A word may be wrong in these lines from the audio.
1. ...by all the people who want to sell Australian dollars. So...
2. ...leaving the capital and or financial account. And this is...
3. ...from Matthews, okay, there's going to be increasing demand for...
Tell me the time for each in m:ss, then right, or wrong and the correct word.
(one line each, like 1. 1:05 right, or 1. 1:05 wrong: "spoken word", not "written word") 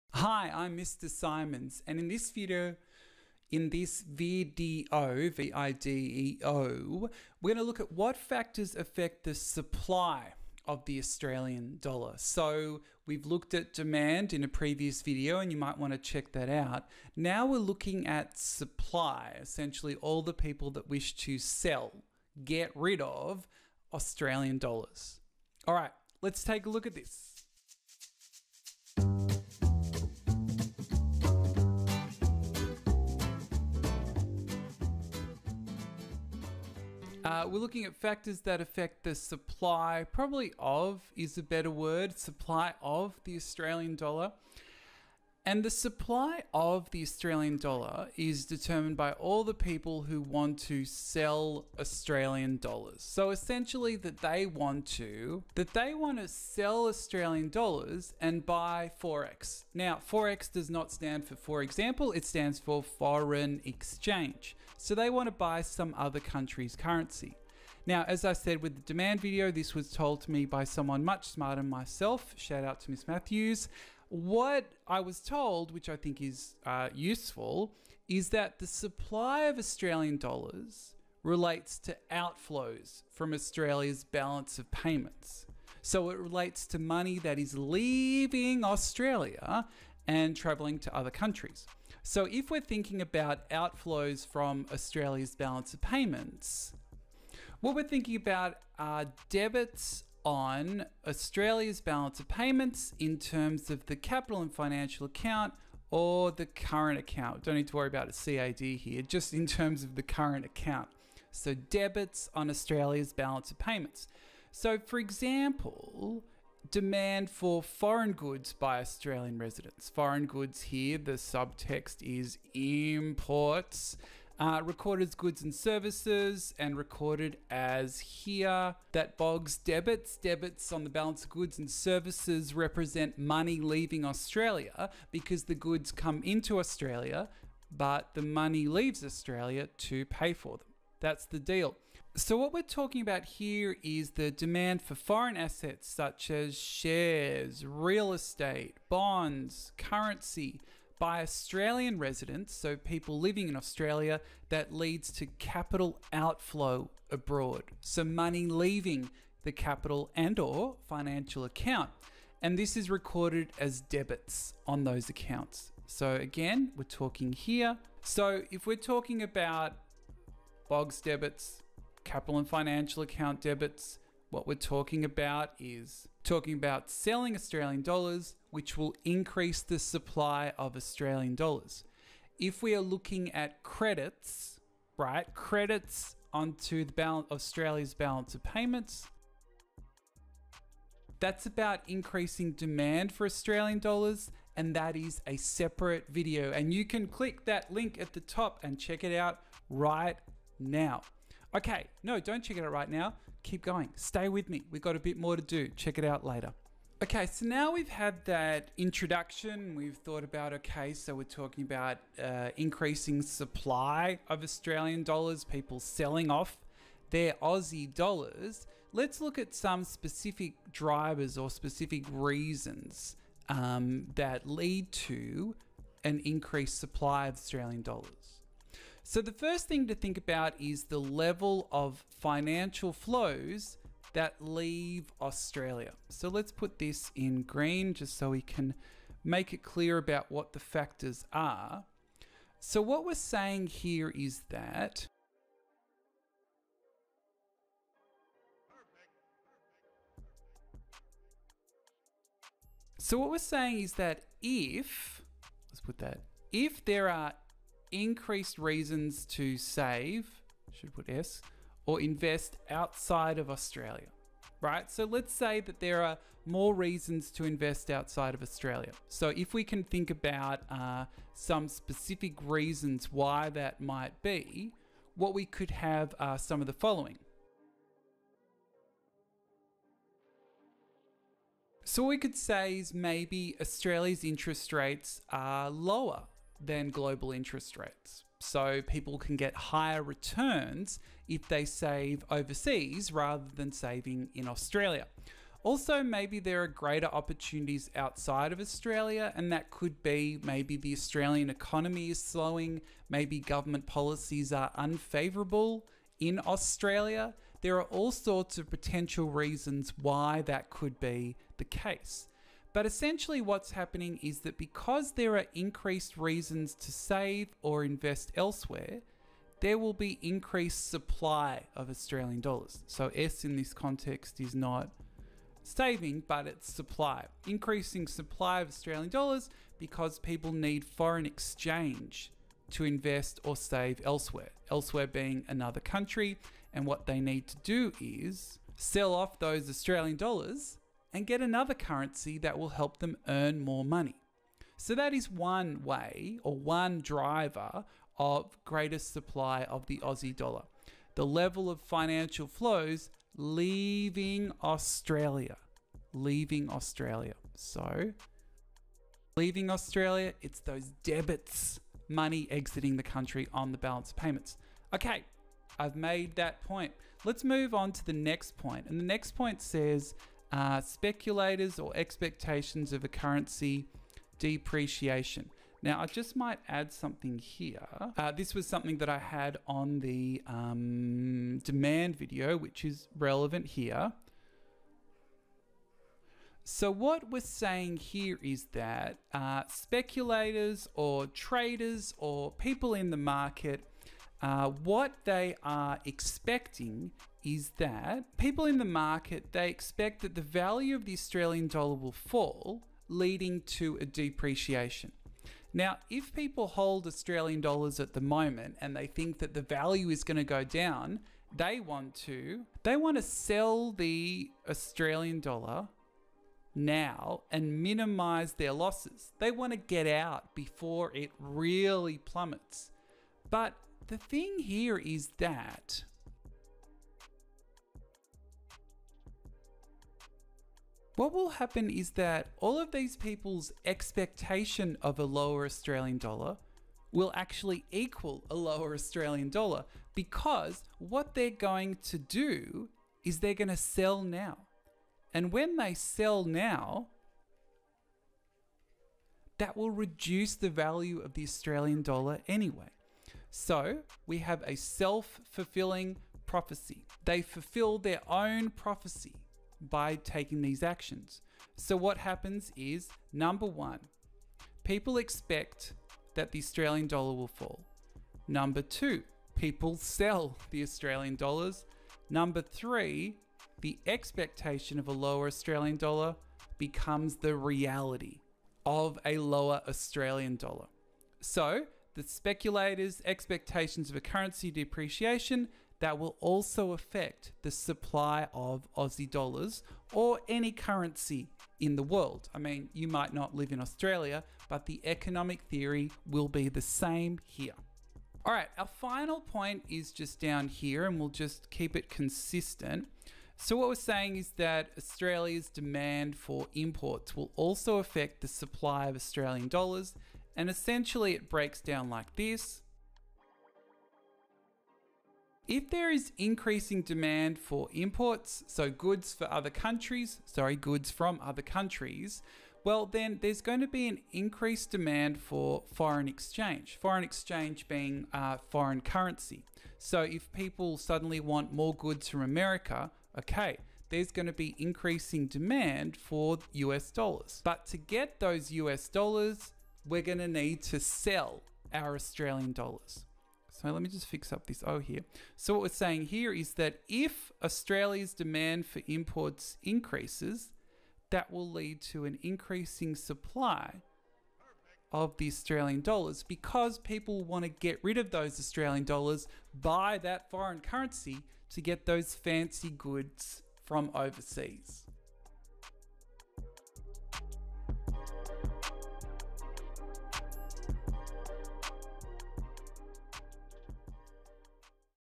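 1. 0:48 right
2. 2:38 right
3. 8:52 wrong: "America", not "Matthews".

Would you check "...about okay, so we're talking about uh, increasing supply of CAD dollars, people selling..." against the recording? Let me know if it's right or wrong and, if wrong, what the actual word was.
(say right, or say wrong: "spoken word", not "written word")
wrong: "Australian", not "CAD".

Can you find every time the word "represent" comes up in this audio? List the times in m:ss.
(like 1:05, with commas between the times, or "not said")
2:12.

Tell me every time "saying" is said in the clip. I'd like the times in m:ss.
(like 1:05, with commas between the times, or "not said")
4:03, 4:13, 6:27, 8:23, 9:05.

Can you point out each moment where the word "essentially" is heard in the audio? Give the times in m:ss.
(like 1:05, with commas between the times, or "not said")
0:19, 0:53, 5:12, 8:30.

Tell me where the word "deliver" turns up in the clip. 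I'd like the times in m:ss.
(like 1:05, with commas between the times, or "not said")
not said.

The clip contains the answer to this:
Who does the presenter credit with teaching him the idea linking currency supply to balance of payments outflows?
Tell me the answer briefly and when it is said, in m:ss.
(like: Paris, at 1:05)
Miss Matthews, at 1:12.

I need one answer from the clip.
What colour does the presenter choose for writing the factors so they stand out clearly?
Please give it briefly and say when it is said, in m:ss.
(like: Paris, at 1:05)
green, at 3:57.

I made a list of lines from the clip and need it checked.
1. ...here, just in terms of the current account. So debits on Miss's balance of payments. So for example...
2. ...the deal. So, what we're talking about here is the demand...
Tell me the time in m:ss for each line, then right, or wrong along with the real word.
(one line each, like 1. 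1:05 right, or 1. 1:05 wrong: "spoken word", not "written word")
1. 1:48 wrong: "Australia", not "Miss"
2. 2:21 right.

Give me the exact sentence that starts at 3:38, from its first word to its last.
Let's look at some specific drivers or specific reasons um, that lead to an increased supply of Australian dollars.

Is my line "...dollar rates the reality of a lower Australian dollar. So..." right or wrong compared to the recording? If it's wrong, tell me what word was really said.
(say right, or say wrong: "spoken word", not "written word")
wrong: "becomes", not "rates".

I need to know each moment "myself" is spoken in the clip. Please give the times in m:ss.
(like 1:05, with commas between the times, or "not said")
1:11.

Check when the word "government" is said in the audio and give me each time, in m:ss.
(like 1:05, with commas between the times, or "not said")
5:03.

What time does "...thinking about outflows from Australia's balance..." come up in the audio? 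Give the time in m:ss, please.
1:32.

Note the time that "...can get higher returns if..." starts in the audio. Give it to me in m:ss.
4:49.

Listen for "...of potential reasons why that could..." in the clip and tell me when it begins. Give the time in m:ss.
5:08.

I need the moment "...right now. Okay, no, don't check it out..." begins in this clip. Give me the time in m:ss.
3:19.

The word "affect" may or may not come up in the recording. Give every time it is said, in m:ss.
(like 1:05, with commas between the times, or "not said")
0:08, 0:38, 8:06, 8:27.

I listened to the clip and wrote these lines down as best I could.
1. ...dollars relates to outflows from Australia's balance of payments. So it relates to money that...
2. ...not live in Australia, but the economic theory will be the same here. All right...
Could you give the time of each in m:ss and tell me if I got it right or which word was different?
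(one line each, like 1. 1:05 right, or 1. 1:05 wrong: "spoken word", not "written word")
1. 1:20 right
2. 8:13 right.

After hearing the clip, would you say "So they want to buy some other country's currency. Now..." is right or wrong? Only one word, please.
right.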